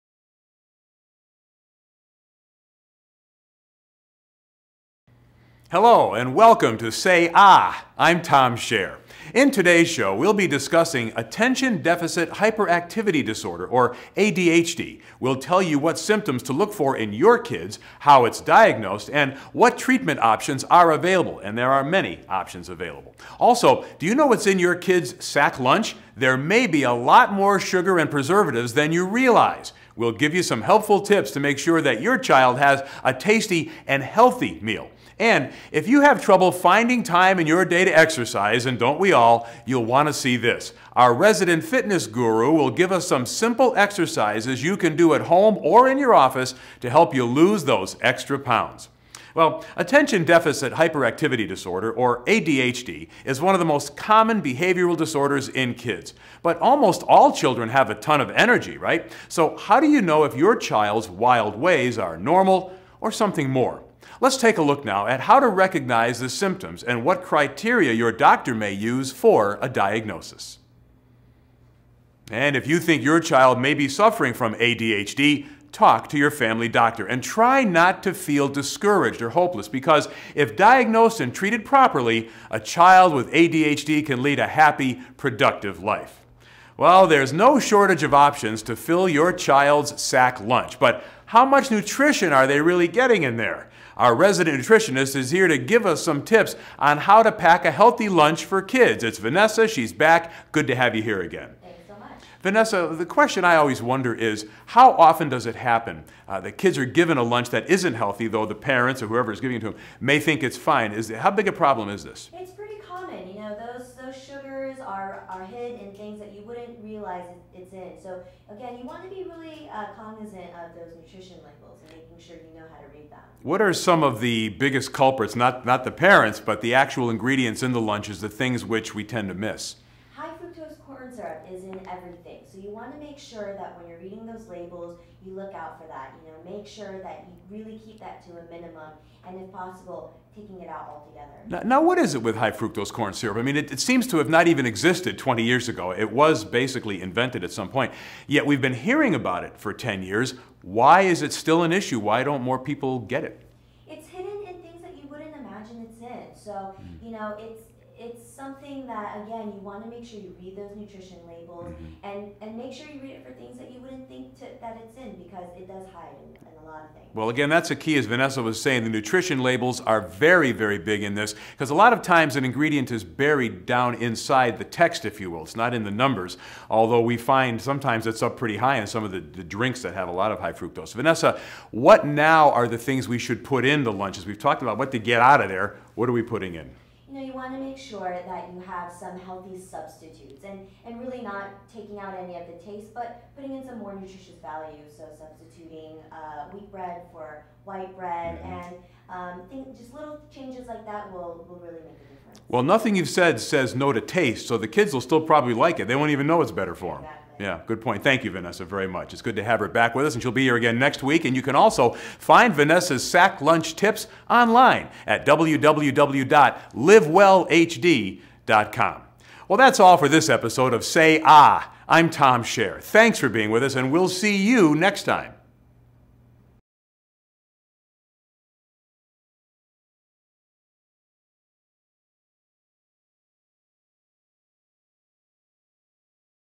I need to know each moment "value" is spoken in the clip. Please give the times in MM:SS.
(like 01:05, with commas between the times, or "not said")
03:14.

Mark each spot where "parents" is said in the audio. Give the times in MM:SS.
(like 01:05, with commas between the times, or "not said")
01:48, 02:05.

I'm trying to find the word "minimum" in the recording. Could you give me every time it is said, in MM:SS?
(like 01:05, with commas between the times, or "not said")
02:18.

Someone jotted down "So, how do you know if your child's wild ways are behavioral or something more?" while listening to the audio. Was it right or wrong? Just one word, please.
wrong.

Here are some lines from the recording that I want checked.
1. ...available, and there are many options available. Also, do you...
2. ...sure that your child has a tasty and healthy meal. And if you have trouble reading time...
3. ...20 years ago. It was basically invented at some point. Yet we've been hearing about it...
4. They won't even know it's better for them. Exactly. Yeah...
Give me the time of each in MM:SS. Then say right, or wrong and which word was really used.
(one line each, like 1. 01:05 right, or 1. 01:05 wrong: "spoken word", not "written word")
1. 00:20 right
2. 00:31 wrong: "finding", not "reading"
3. 02:25 right
4. 03:25 right.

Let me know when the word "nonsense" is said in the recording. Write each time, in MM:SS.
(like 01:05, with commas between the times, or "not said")
not said.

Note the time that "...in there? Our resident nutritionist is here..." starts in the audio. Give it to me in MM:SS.
01:33.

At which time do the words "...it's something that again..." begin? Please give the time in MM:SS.
02:38.